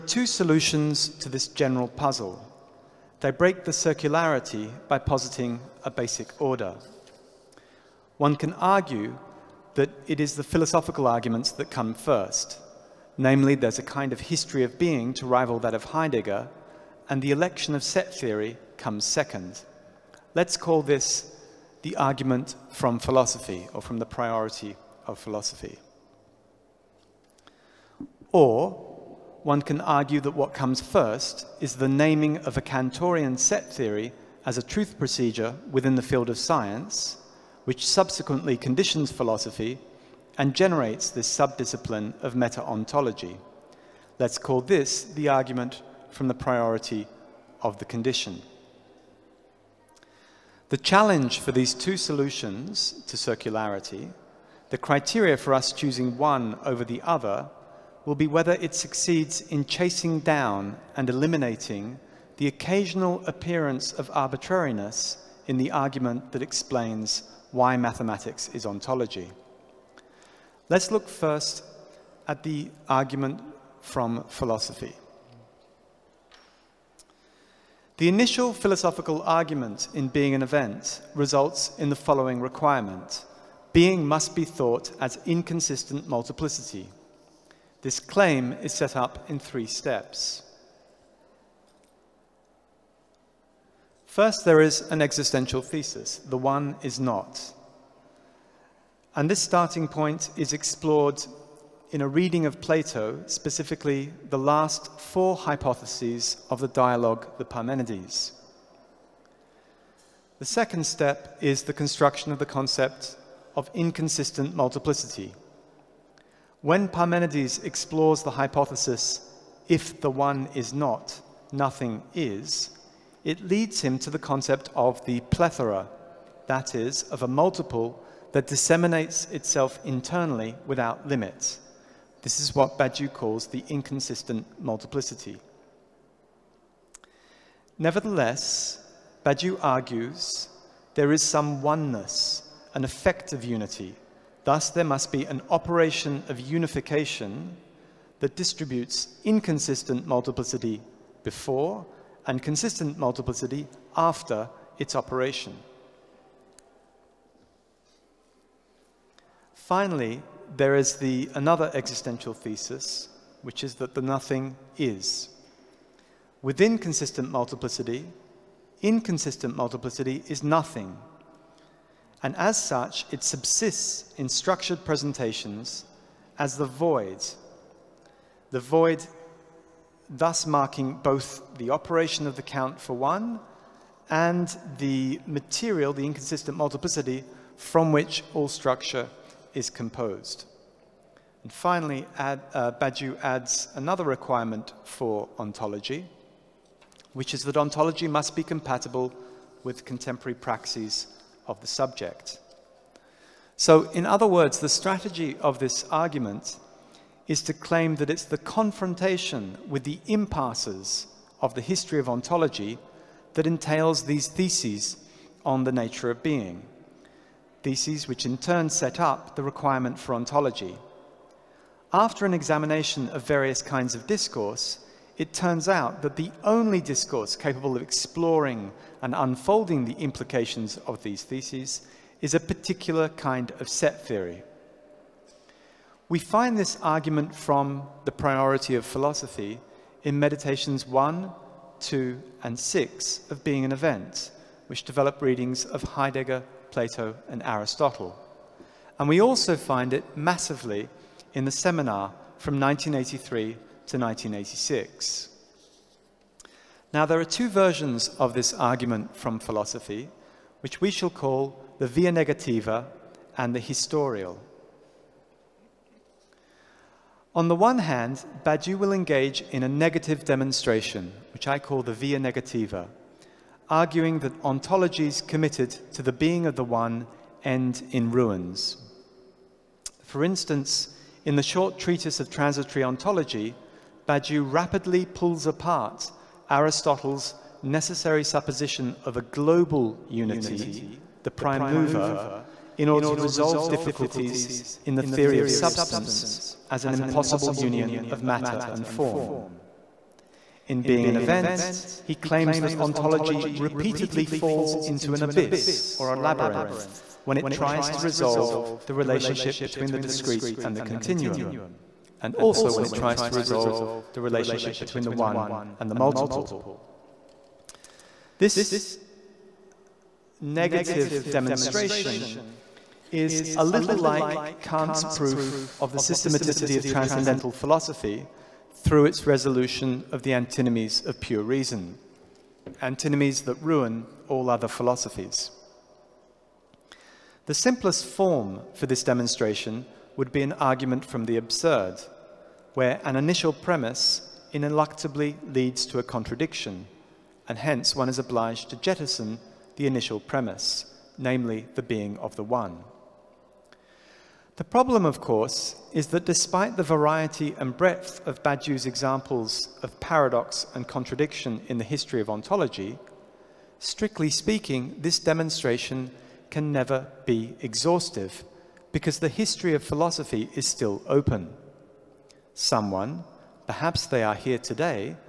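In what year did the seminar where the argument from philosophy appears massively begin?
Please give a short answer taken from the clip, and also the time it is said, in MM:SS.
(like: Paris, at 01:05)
1983, at 04:12.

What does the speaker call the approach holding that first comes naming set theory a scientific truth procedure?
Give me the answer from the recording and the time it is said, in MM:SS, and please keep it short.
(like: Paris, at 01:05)
argument from the priority of the condition, at 00:45.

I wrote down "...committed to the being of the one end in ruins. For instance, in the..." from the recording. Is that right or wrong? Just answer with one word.
right.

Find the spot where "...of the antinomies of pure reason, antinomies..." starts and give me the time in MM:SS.
05:30.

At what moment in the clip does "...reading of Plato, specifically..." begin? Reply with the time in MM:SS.
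01:42.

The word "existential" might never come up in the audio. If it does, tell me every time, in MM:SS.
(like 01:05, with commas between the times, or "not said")
01:35, 02:41.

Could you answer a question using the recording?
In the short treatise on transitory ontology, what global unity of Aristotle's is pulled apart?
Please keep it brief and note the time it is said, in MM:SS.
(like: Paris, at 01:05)
the prime mover, at 04:51.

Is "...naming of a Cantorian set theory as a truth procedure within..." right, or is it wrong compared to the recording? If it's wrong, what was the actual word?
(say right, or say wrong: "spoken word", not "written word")
right.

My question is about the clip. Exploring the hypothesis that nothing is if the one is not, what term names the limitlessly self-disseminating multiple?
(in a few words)
plethora.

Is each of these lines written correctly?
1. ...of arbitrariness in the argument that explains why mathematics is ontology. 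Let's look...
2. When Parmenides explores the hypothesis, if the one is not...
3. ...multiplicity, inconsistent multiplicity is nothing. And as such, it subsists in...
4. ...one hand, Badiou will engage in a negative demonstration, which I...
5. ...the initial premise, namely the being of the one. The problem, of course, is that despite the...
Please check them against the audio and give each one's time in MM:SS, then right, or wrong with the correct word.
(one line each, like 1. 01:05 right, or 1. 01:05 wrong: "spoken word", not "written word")
1. 01:03 right
2. 01:56 right
3. 02:47 right
4. 04:27 right
5. 05:49 right.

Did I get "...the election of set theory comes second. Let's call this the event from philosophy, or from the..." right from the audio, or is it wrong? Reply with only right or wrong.
wrong.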